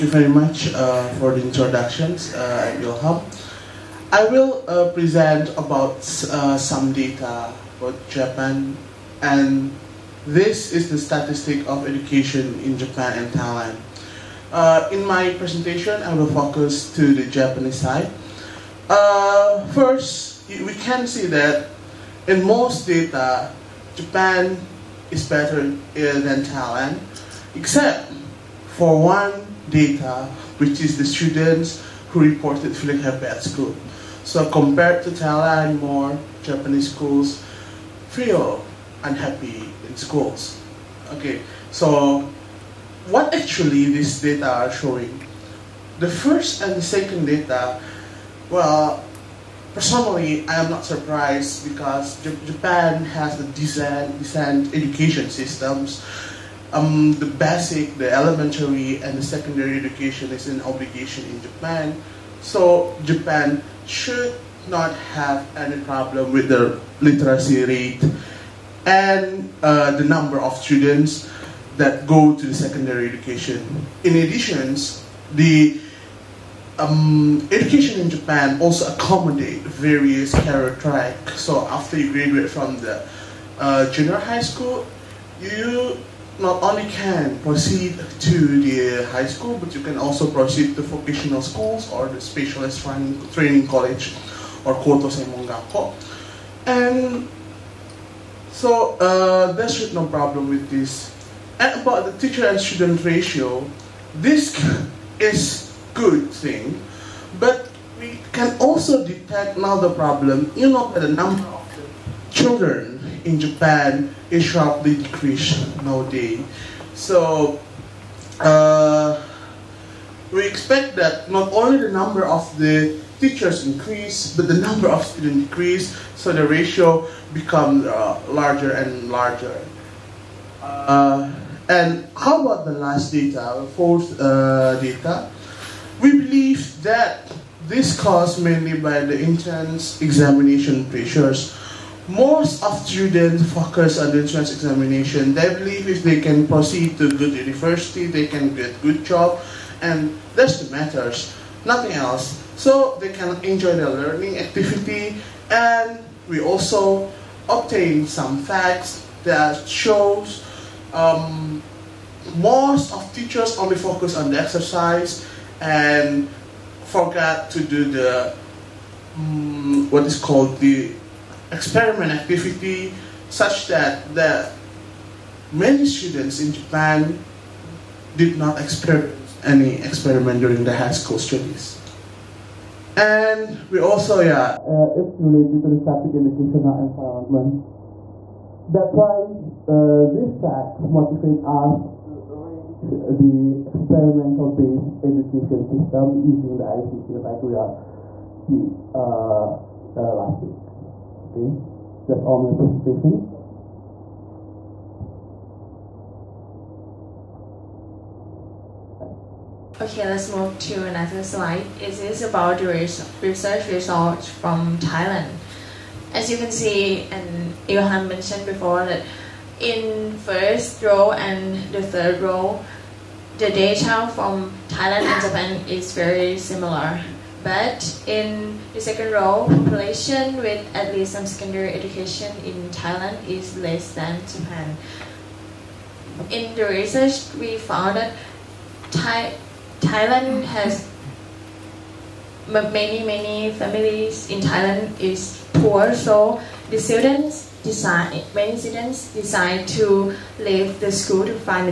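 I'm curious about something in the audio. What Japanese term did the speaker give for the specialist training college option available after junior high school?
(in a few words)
Koto Senmongakko.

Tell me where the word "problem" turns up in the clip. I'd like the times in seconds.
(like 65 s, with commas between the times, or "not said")
65 s, 100 s, 109 s.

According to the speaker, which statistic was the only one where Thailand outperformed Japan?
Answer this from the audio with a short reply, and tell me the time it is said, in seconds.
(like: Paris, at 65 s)
students who reported feeling happy at school, at 31 s.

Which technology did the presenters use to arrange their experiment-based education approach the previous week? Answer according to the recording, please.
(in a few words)
ICT.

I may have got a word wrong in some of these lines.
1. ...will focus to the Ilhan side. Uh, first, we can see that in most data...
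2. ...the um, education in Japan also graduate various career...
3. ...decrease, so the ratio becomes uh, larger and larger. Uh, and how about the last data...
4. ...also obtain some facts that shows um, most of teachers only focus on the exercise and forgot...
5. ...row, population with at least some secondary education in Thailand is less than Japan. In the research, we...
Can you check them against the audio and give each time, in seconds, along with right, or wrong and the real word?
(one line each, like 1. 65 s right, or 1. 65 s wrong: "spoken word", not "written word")
1. 16 s wrong: "Japanese", not "Ilhan"
2. 75 s wrong: "accommodate", not "graduate"
3. 125 s right
4. 156 s right
5. 229 s right.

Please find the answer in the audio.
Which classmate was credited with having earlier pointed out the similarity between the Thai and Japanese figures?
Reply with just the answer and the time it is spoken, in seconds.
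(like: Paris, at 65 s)
Ilhan, at 217 s.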